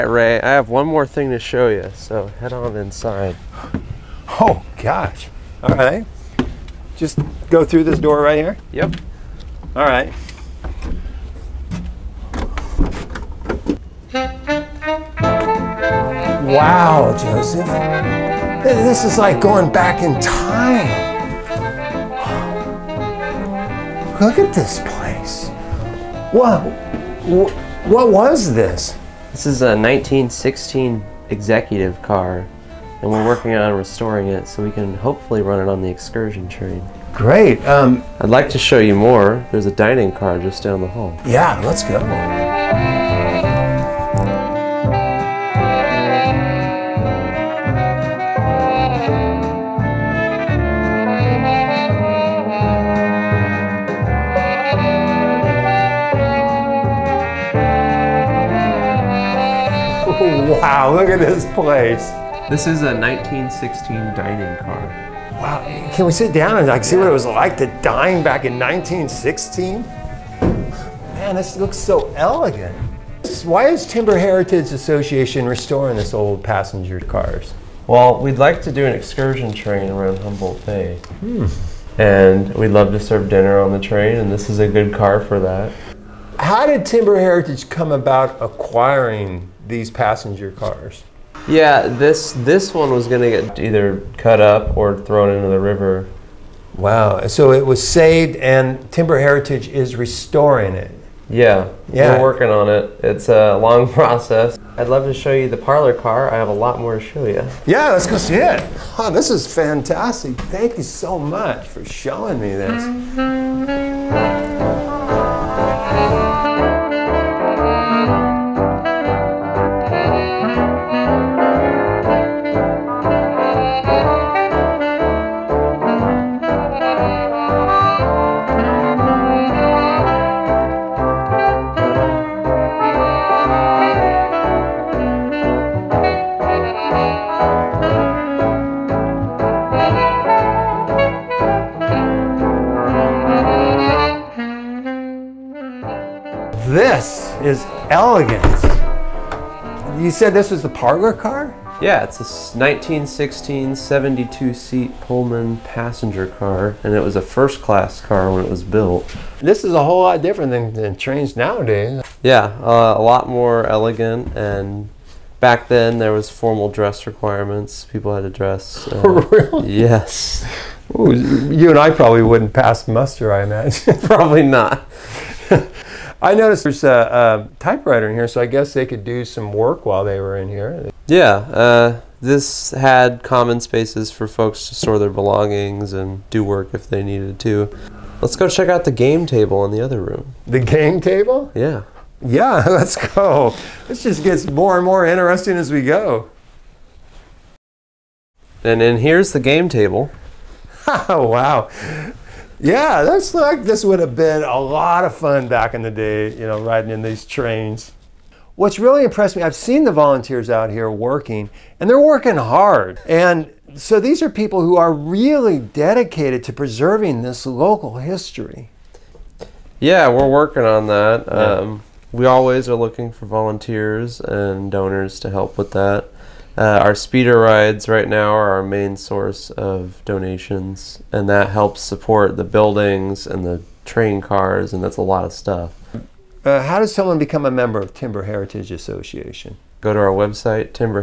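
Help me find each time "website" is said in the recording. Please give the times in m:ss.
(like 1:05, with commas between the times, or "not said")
4:00.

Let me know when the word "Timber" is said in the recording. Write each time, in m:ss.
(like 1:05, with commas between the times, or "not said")
1:13, 1:26, 1:38, 3:57.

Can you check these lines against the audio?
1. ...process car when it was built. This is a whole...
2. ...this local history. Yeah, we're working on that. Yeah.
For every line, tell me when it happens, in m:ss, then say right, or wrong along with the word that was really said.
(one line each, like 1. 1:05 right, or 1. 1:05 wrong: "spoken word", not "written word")
1. 2:37 wrong: "class", not "process"
2. 3:37 right.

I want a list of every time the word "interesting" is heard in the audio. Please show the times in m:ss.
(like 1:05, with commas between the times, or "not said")
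3:15.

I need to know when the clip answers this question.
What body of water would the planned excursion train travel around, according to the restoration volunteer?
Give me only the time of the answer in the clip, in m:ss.
1:20.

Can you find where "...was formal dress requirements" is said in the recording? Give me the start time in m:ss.
2:46.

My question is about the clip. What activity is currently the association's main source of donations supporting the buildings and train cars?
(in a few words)
speeder rides.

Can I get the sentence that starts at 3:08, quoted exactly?
Let's go check out the game table in the other room.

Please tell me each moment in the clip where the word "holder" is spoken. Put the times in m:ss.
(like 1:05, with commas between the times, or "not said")
not said.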